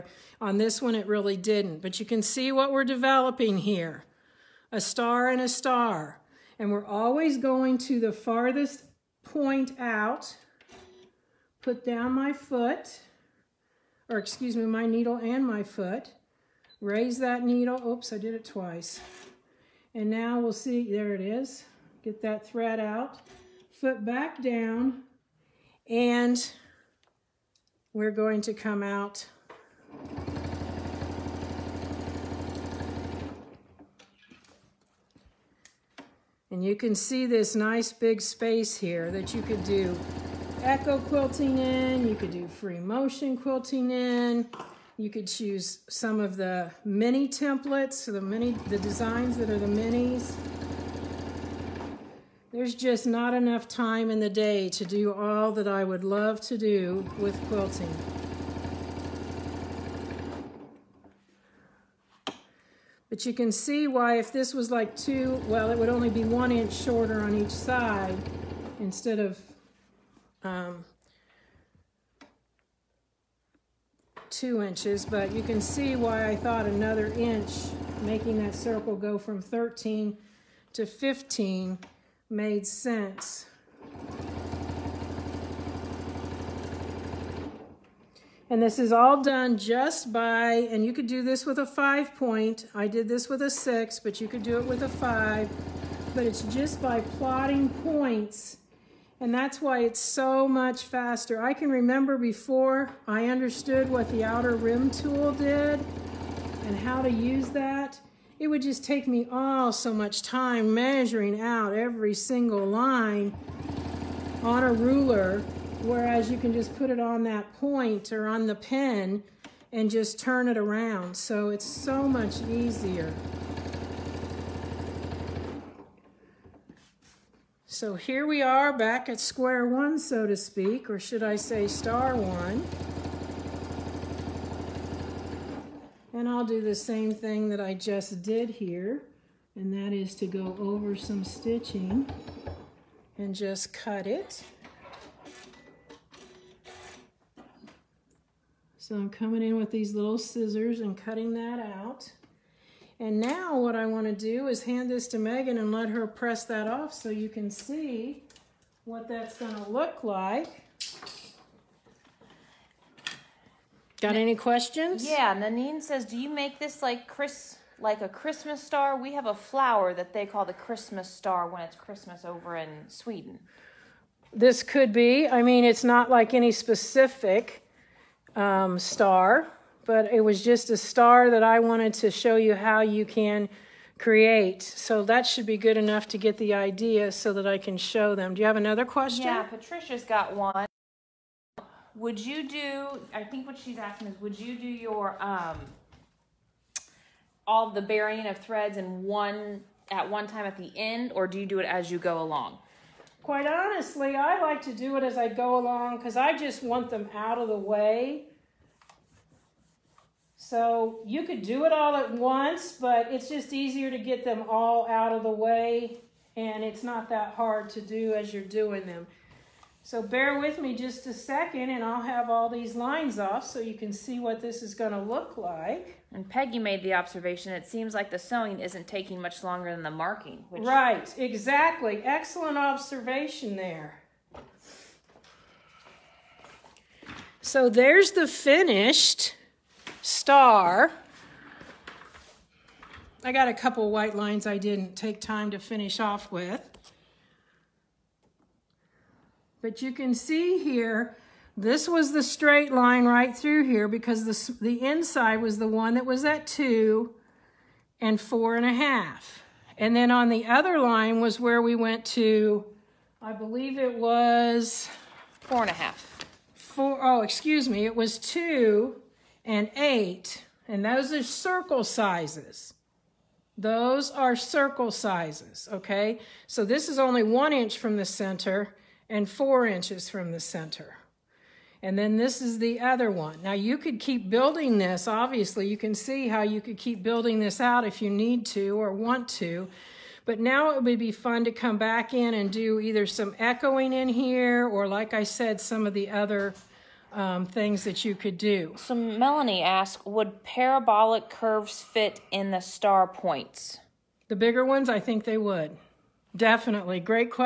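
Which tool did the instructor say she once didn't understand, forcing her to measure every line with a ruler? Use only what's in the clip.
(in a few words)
outer rim tool.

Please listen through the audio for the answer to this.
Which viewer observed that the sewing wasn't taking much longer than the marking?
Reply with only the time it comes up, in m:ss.
3:46.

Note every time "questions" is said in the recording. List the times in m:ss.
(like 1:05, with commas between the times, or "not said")
2:44, 3:08.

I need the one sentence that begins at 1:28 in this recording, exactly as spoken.
And this is all done just by, and you could do this with a five point.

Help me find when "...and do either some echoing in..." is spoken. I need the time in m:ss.
4:52.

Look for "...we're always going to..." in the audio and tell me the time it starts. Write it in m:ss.
0:06.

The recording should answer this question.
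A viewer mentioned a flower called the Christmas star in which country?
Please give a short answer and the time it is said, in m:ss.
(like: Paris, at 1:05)
Sweden, at 2:52.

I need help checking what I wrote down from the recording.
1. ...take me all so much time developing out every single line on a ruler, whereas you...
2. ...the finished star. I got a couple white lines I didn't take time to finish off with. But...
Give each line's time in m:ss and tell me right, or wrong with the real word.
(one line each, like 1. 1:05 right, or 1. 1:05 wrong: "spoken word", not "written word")
1. 1:48 wrong: "measuring", not "developing"
2. 3:58 right.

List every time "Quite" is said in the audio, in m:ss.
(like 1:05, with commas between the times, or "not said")
3:23.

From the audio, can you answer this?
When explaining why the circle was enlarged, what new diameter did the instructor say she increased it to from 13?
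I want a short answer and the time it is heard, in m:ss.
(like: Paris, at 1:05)
15, at 1:20.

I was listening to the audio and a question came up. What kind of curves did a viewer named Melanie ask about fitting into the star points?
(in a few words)
parabolic curves.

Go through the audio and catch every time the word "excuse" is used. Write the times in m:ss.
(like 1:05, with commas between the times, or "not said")
0:14, 4:27.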